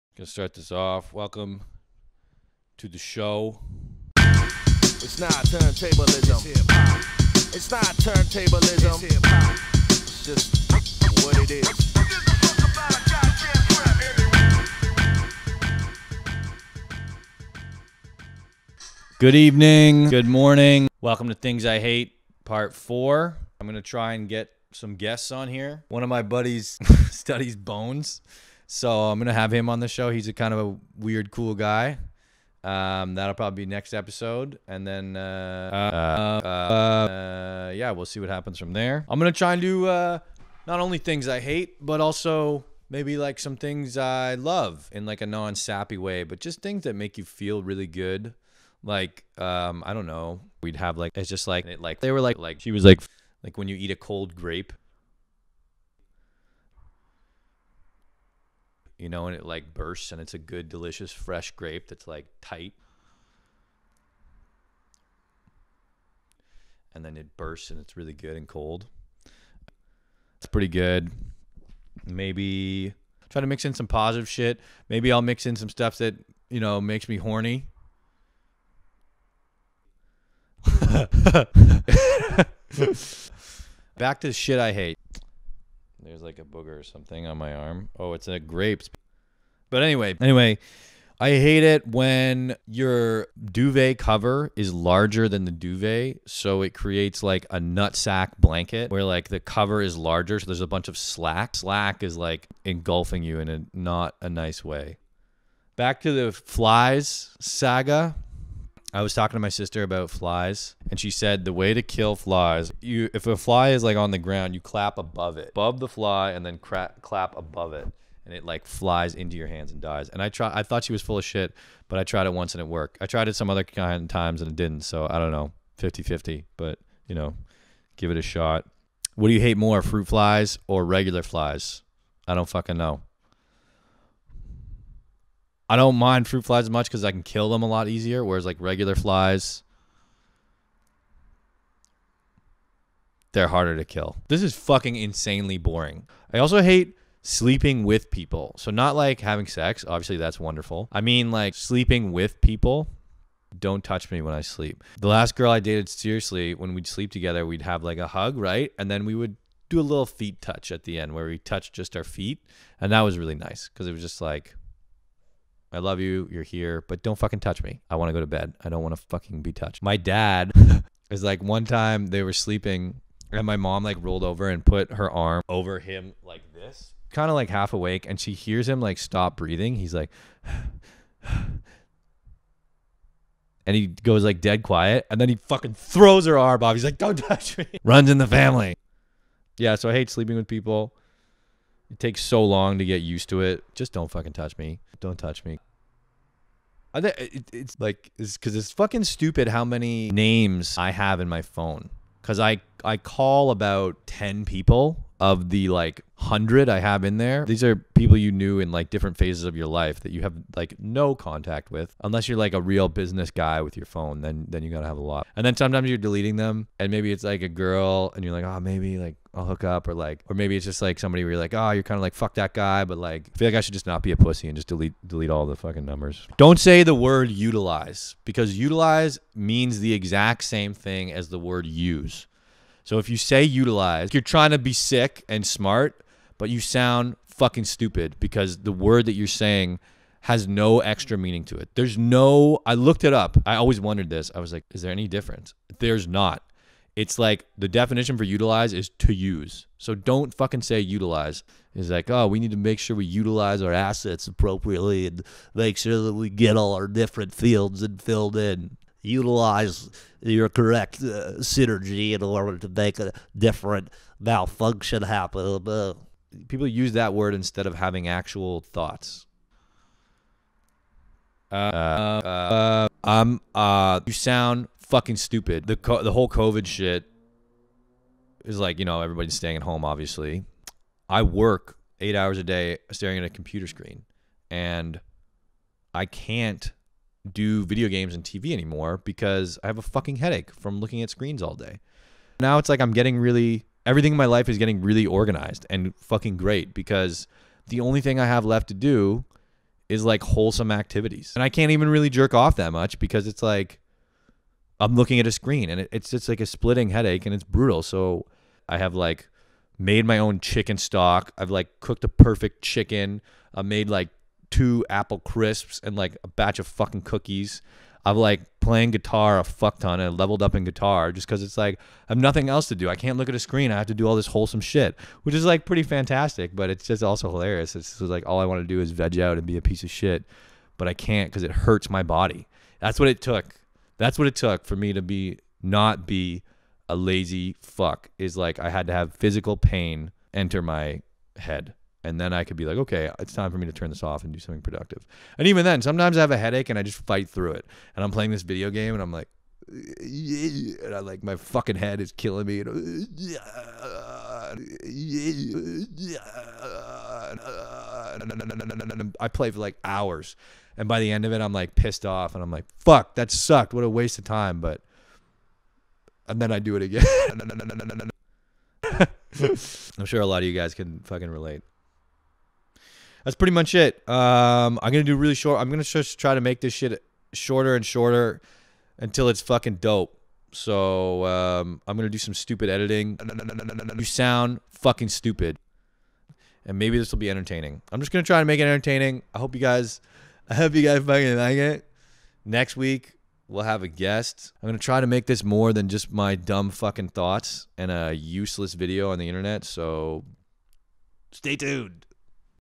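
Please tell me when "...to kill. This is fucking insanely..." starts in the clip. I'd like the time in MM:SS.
02:23.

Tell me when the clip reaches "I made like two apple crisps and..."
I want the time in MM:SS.
05:13.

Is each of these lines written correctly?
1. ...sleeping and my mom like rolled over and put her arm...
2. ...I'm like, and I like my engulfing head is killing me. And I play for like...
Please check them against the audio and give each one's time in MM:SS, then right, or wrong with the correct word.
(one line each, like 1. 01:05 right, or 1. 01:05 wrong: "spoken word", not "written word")
1. 02:52 right
2. 05:49 wrong: "fucking", not "engulfing".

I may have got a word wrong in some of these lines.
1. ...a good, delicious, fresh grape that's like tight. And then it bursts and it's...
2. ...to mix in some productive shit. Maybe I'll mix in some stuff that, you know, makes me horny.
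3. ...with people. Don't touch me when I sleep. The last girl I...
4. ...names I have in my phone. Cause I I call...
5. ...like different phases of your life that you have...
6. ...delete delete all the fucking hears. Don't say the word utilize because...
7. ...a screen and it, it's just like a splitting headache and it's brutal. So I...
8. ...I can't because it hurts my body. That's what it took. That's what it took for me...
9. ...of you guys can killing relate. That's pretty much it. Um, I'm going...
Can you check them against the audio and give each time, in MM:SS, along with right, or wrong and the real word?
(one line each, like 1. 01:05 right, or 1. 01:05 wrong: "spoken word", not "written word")
1. 01:00 right
2. 01:13 wrong: "positive", not "productive"
3. 02:32 right
4. 03:20 right
5. 03:28 right
6. 03:44 wrong: "numbers", not "hears"
7. 05:05 right
8. 05:30 right
9. 06:10 wrong: "fucking", not "killing".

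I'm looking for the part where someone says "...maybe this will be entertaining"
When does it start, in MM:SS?
06:26.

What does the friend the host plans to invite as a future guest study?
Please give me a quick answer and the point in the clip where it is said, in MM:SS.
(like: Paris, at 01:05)
Bones, at 00:27.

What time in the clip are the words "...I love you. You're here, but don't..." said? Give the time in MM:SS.
02:45.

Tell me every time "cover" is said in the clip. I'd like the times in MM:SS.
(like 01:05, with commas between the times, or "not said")
01:33, 01:39.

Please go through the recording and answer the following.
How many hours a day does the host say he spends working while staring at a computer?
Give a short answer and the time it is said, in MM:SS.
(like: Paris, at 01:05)
8, at 04:41.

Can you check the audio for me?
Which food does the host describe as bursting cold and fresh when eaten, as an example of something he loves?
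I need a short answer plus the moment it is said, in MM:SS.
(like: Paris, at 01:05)
A cold grape, at 00:53.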